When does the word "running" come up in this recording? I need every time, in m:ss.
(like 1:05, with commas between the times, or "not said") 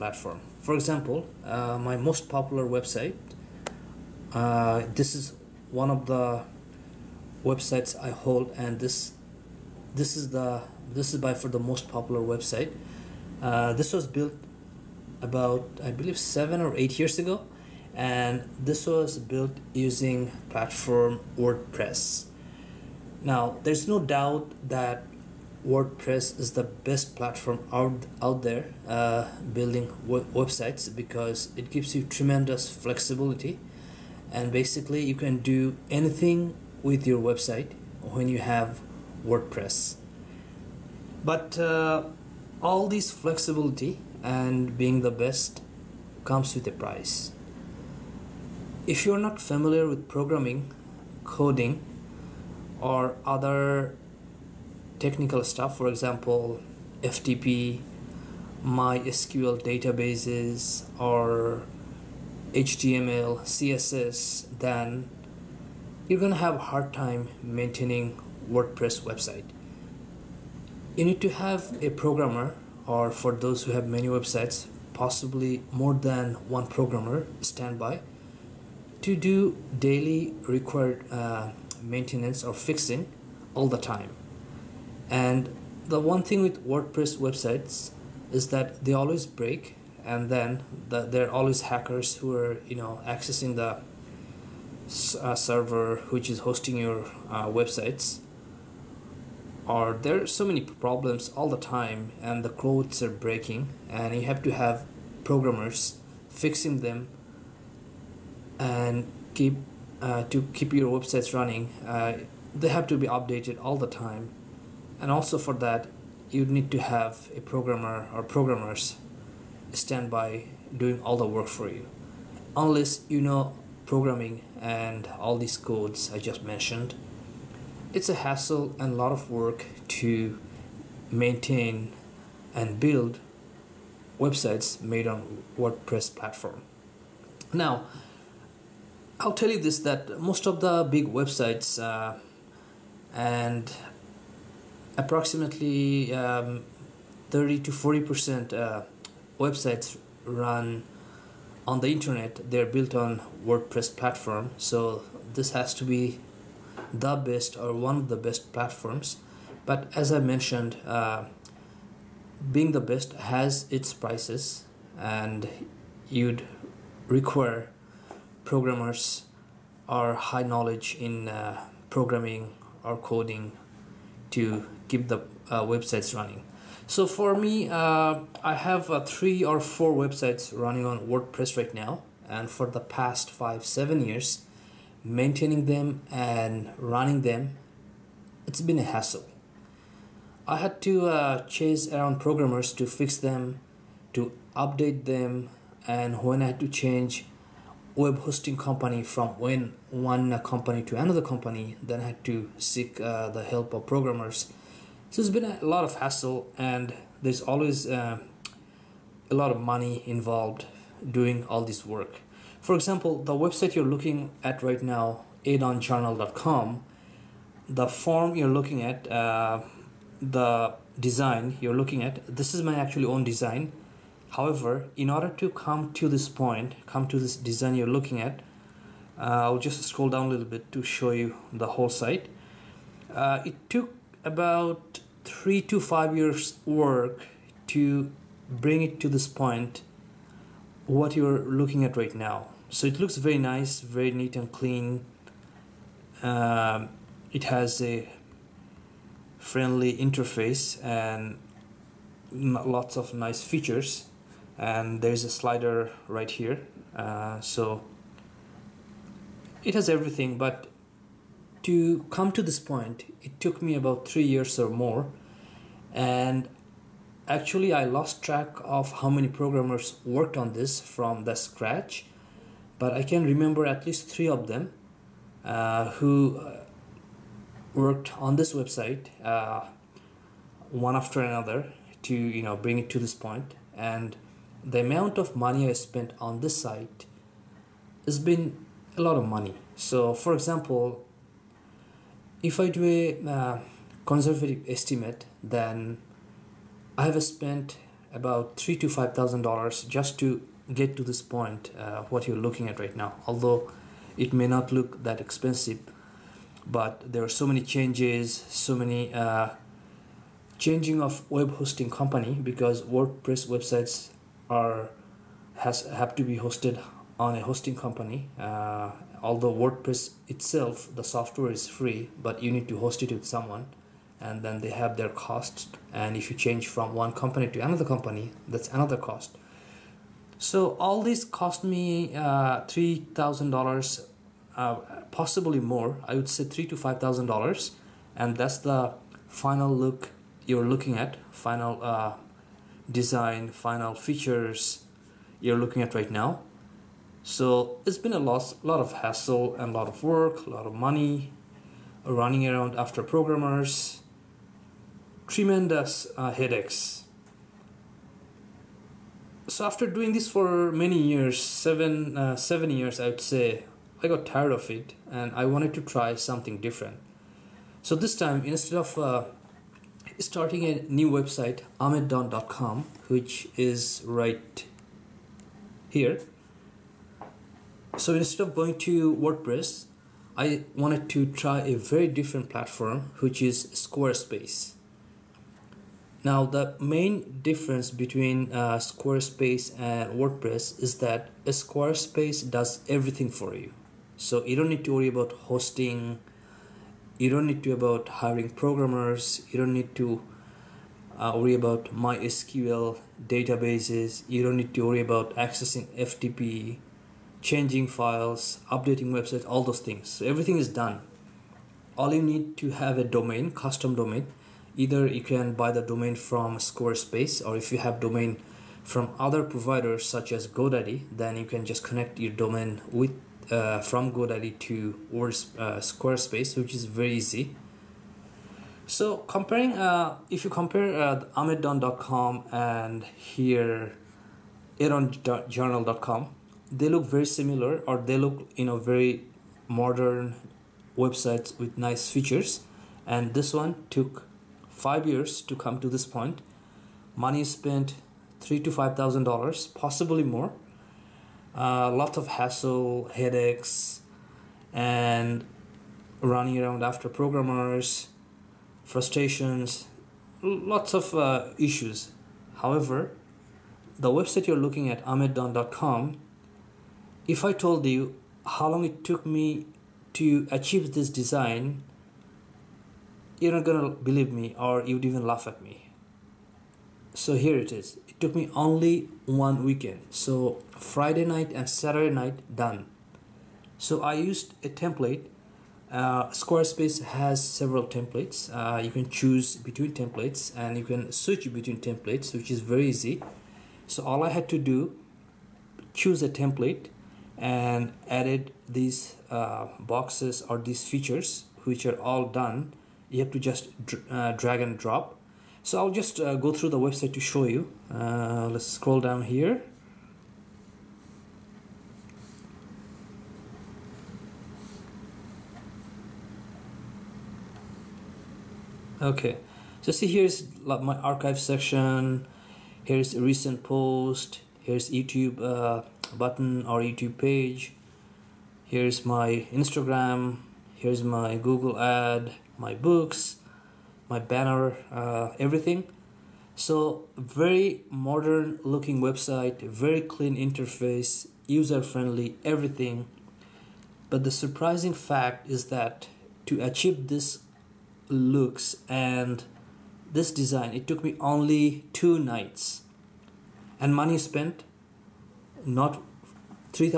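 1:51, 2:56, 3:00, 3:06, 5:52, 7:36.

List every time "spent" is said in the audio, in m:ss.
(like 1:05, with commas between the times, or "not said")
4:45, 4:57, 7:27, 9:14.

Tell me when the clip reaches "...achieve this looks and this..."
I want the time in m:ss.
9:06.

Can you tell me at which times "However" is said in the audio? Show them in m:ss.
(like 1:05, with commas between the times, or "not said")
3:44, 7:42.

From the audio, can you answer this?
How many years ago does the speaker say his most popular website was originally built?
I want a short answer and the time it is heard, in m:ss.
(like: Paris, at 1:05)
7 or 8 years, at 0:16.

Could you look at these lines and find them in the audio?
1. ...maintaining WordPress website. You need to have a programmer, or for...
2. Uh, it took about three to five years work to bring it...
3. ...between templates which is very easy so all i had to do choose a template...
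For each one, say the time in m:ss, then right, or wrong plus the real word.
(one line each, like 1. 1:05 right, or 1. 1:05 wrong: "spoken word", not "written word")
1. 1:07 right
2. 3:53 right
3. 8:11 right.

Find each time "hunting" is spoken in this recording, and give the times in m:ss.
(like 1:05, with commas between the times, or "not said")
not said.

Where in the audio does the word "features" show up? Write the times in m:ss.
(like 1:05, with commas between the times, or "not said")
4:13, 5:43, 7:22, 8:20.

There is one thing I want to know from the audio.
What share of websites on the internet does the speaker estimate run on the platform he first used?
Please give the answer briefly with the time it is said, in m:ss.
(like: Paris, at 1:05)
30 to 40 percent, at 2:27.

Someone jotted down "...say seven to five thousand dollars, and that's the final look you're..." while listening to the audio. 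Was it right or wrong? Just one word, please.
wrong.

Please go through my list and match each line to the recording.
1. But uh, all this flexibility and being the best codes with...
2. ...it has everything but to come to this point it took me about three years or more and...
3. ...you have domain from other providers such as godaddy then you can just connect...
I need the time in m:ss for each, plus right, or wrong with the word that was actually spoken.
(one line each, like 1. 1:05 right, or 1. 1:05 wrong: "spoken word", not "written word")
1. 0:41 wrong: "comes", not "codes"
2. 4:19 right
3. 6:57 right.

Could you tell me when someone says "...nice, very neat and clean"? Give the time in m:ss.
4:03.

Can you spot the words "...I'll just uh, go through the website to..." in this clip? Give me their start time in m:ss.
8:25.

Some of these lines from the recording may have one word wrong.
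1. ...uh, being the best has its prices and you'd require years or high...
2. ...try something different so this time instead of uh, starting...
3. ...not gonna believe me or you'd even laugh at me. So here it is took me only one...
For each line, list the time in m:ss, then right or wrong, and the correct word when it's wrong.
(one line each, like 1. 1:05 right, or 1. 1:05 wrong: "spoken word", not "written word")
1. 2:40 wrong: "programmers", not "years"
2. 6:05 right
3. 7:53 right.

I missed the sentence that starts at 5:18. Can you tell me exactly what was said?
Uh, although WordPress itself, the software is free, but you need to host it with someone, and then they have their costs.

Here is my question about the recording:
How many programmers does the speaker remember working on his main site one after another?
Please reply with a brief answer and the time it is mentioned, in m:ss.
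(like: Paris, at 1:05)
3, at 4:33.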